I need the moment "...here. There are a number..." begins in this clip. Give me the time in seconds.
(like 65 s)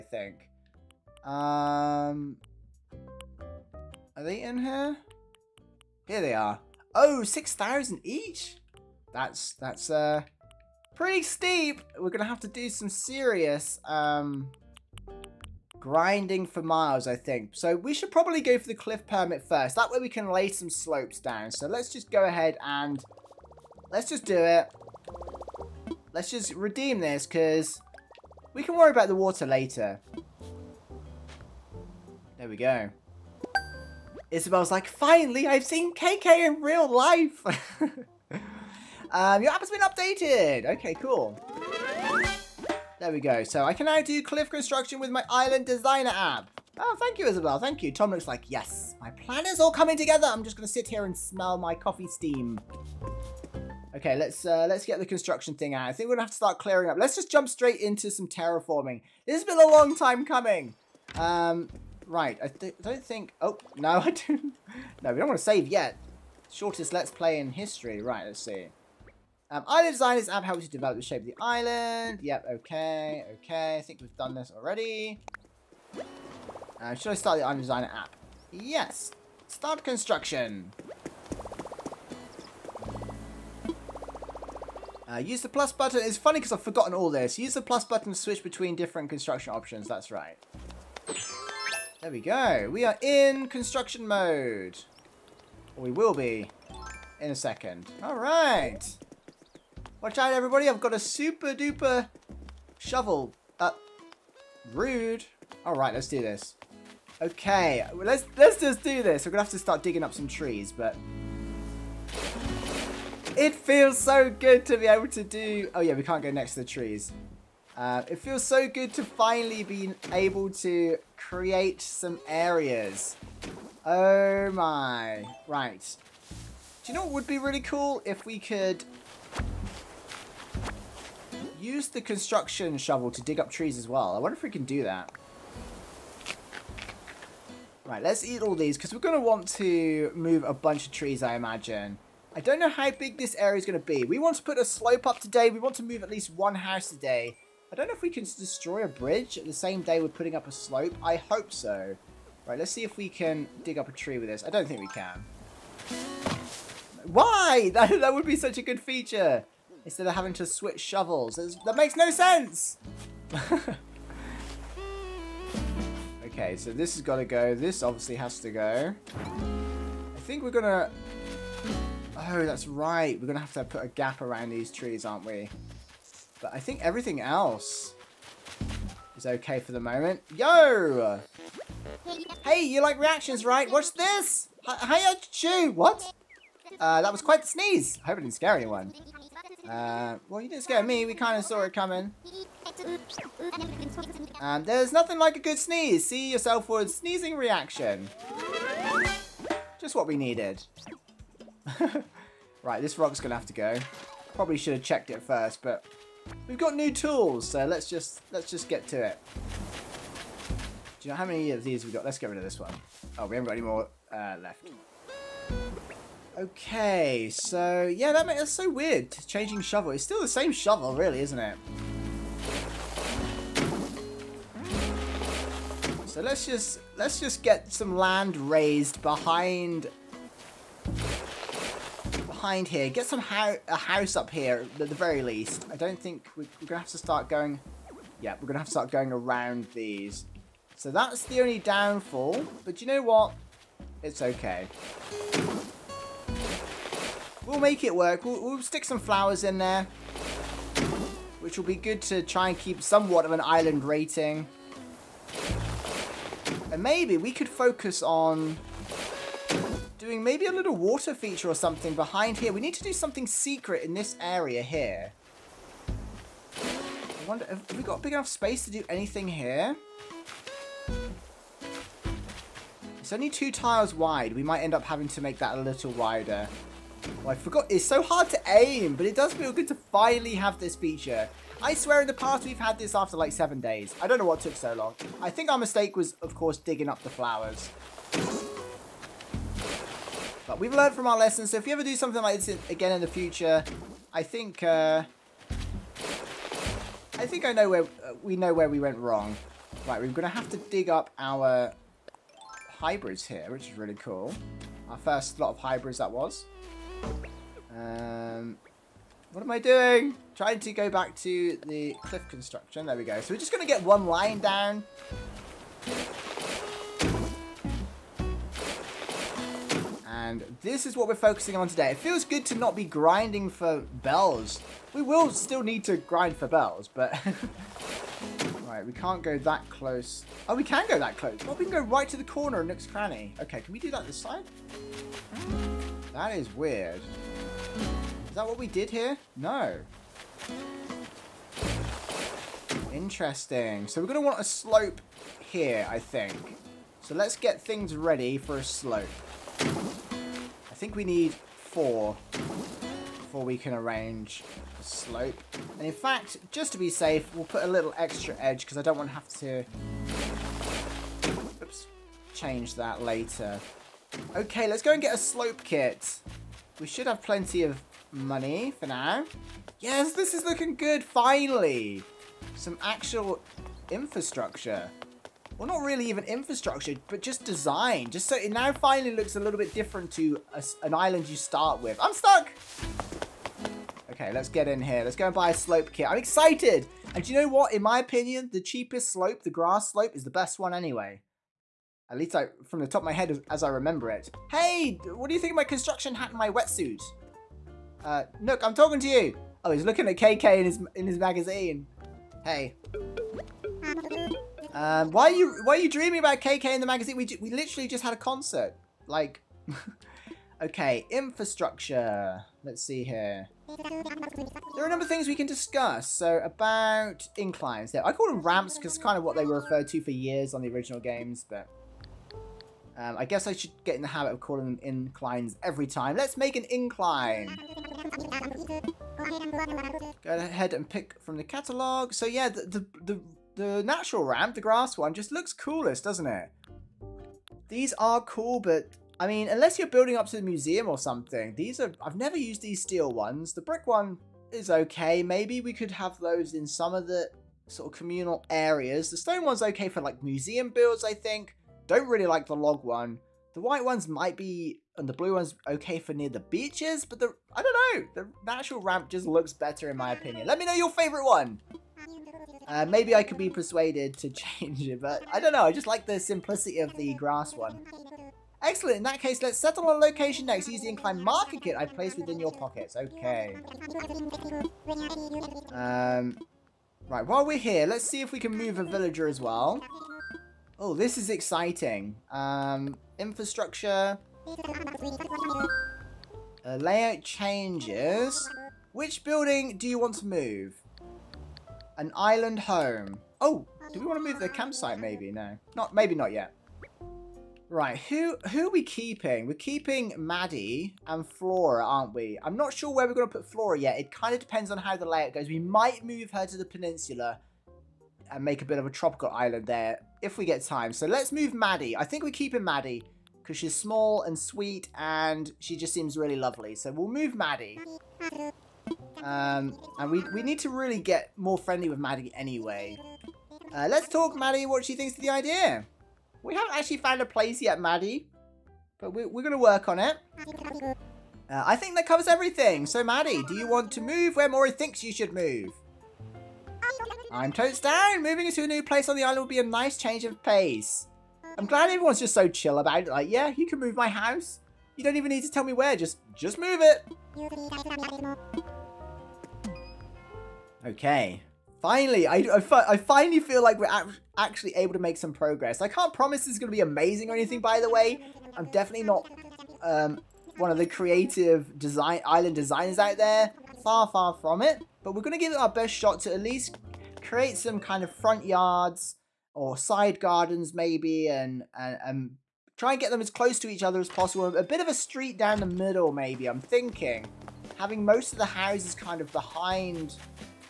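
413 s.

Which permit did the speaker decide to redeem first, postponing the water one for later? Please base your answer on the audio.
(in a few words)
cliff permit.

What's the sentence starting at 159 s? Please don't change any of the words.
Instead of having to switch shovels.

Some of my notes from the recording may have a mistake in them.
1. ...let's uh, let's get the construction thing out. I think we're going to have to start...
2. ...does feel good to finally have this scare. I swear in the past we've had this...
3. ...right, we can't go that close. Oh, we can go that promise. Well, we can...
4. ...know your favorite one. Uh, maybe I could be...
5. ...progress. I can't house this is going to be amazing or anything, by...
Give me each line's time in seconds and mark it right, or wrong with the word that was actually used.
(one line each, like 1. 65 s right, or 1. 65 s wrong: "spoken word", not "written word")
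1. 54 s right
2. 279 s wrong: "feature", not "scare"
3. 328 s wrong: "close", not "promise"
4. 460 s right
5. 555 s wrong: "promise", not "house".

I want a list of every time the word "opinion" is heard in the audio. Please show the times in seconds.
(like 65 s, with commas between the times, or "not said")
387 s, 460 s.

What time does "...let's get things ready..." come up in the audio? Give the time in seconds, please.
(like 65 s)
347 s.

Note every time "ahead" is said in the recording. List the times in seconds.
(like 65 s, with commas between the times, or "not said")
22 s, 430 s.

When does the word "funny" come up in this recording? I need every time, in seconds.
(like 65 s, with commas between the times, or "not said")
86 s.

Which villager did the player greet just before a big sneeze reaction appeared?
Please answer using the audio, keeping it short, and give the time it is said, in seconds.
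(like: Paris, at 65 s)
Chew, at 185 s.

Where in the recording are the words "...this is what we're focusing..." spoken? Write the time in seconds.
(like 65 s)
320 s.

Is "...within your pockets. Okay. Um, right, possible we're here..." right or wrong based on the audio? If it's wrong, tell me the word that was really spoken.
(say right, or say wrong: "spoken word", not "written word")
wrong: "while", not "possible".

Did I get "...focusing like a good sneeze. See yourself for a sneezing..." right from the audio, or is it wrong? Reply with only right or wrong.
wrong.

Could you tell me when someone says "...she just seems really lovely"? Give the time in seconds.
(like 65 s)
515 s.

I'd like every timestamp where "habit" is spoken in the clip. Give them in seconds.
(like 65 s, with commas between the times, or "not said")
424 s.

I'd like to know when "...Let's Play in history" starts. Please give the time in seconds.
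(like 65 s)
66 s.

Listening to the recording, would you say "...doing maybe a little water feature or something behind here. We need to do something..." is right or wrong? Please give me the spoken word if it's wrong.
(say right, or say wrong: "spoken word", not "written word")
right.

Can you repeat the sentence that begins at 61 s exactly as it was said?
Um, Right, I th don't think...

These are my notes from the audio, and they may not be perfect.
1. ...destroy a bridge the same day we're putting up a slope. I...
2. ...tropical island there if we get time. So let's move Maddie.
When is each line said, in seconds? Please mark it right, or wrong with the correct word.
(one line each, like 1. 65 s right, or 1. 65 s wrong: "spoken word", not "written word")
1. 148 s right
2. 508 s right.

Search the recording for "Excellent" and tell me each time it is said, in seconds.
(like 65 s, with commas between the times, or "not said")
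468 s.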